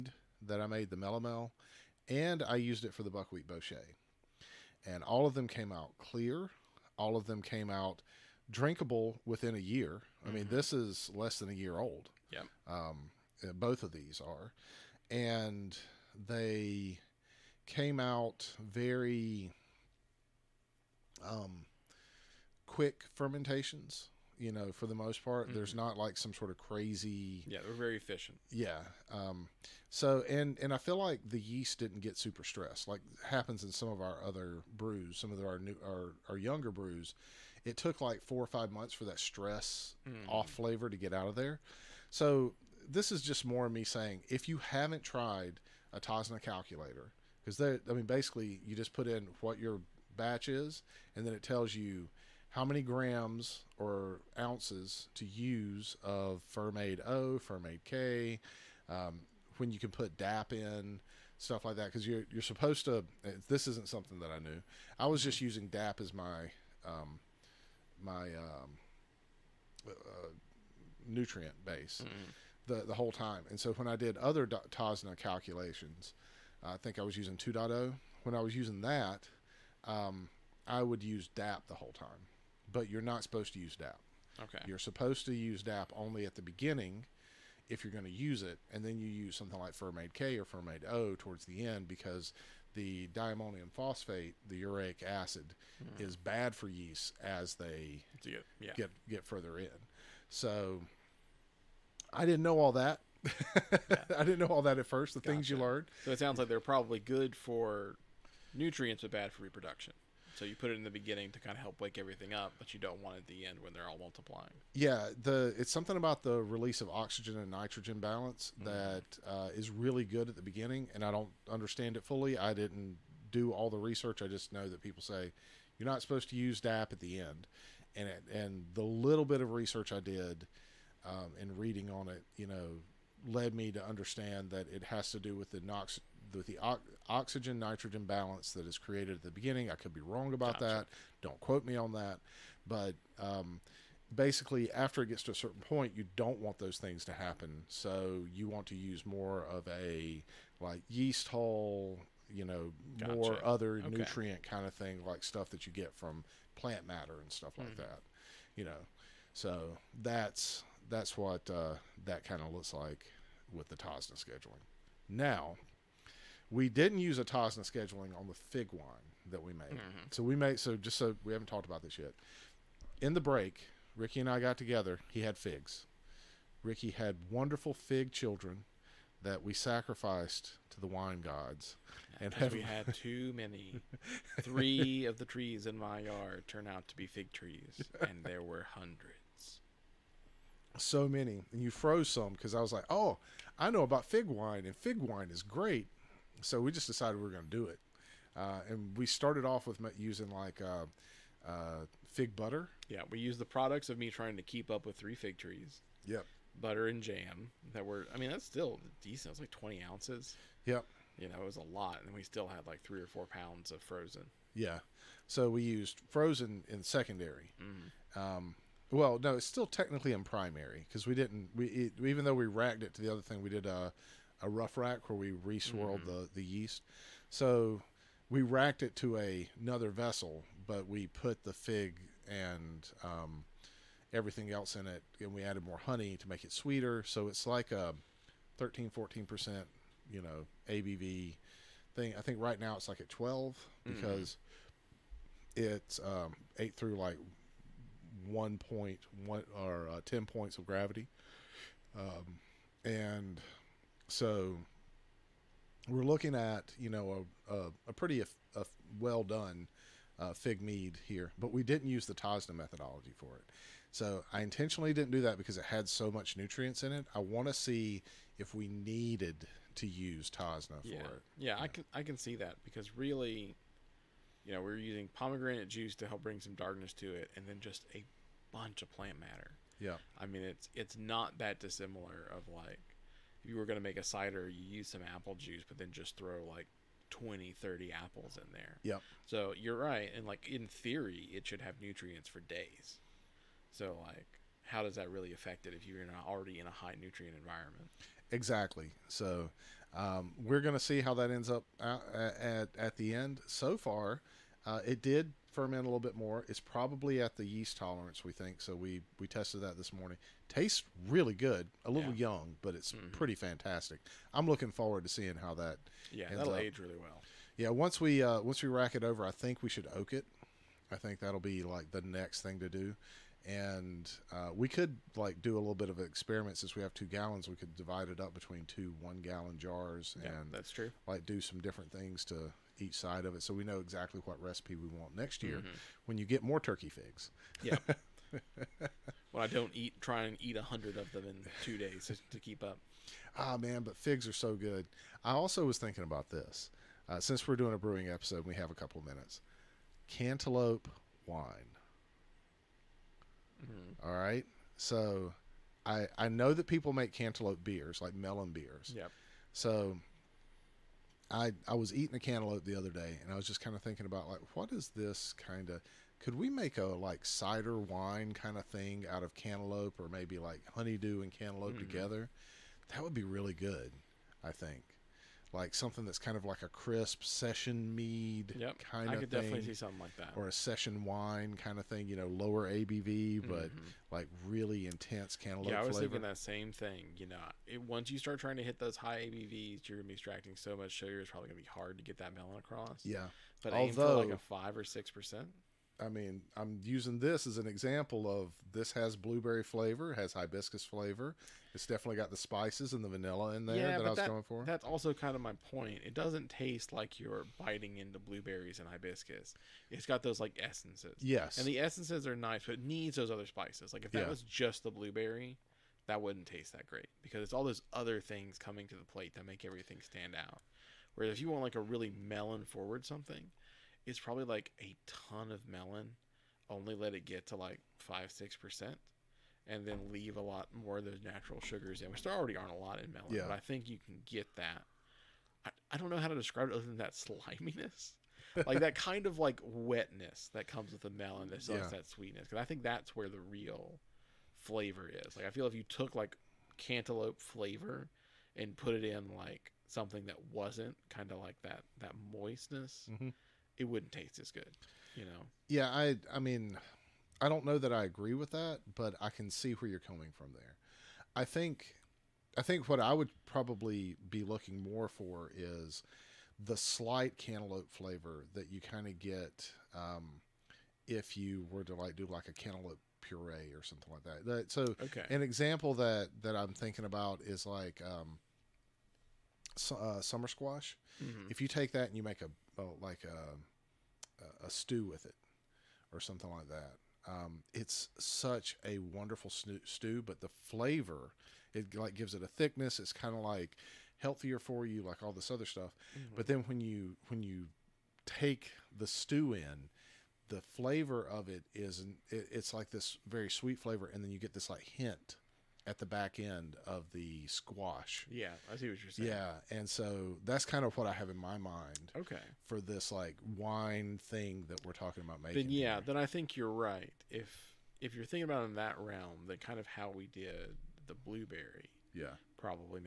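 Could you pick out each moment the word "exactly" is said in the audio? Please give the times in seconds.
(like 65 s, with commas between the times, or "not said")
298 s, 333 s.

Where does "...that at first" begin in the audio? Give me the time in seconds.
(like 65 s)
104 s.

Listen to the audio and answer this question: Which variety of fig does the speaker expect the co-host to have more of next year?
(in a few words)
turkey figs.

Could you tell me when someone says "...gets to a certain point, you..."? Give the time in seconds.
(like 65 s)
145 s.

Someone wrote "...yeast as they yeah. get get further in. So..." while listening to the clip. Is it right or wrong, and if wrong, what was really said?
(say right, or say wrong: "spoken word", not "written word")
right.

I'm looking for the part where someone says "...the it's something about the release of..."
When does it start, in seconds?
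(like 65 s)
115 s.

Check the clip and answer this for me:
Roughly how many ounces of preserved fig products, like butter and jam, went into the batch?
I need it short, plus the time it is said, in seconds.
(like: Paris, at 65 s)
20, at 209 s.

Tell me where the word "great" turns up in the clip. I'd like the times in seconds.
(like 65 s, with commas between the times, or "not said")
195 s, 416 s.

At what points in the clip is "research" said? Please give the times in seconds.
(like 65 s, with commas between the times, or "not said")
123 s, 129 s.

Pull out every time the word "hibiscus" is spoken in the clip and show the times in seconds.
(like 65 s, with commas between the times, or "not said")
400 s, 408 s.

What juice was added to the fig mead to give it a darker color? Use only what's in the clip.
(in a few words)
pomegranate juice.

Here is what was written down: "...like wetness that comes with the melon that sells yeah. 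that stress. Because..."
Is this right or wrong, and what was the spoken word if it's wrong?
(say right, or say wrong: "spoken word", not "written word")
wrong: "sweetness", not "stress".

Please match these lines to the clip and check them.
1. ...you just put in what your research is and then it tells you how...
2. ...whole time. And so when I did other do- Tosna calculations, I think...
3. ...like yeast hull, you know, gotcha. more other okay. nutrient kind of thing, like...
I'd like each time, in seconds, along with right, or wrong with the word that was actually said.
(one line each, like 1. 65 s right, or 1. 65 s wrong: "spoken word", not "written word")
1. 48 s wrong: "batch", not "research"
2. 72 s right
3. 150 s right.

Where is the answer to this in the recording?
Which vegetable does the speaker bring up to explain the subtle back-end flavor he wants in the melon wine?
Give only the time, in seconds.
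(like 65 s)
480 s.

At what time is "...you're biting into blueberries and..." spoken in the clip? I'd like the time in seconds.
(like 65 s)
407 s.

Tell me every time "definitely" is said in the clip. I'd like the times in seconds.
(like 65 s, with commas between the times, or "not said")
379 s, 401 s.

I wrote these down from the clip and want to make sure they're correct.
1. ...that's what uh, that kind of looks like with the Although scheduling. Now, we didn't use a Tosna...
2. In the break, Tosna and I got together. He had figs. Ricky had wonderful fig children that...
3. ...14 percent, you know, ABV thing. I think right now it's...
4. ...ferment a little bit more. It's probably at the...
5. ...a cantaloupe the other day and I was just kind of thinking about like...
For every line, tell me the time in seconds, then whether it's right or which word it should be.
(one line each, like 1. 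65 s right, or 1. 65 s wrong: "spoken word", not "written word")
1. 160 s wrong: "Tosna", not "Although"
2. 173 s wrong: "Ricky", not "Tosna"
3. 238 s right
4. 305 s right
5. 362 s right.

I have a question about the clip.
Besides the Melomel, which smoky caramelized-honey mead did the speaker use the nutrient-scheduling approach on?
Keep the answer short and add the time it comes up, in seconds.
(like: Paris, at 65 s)
buckwheat bochet, at 3 s.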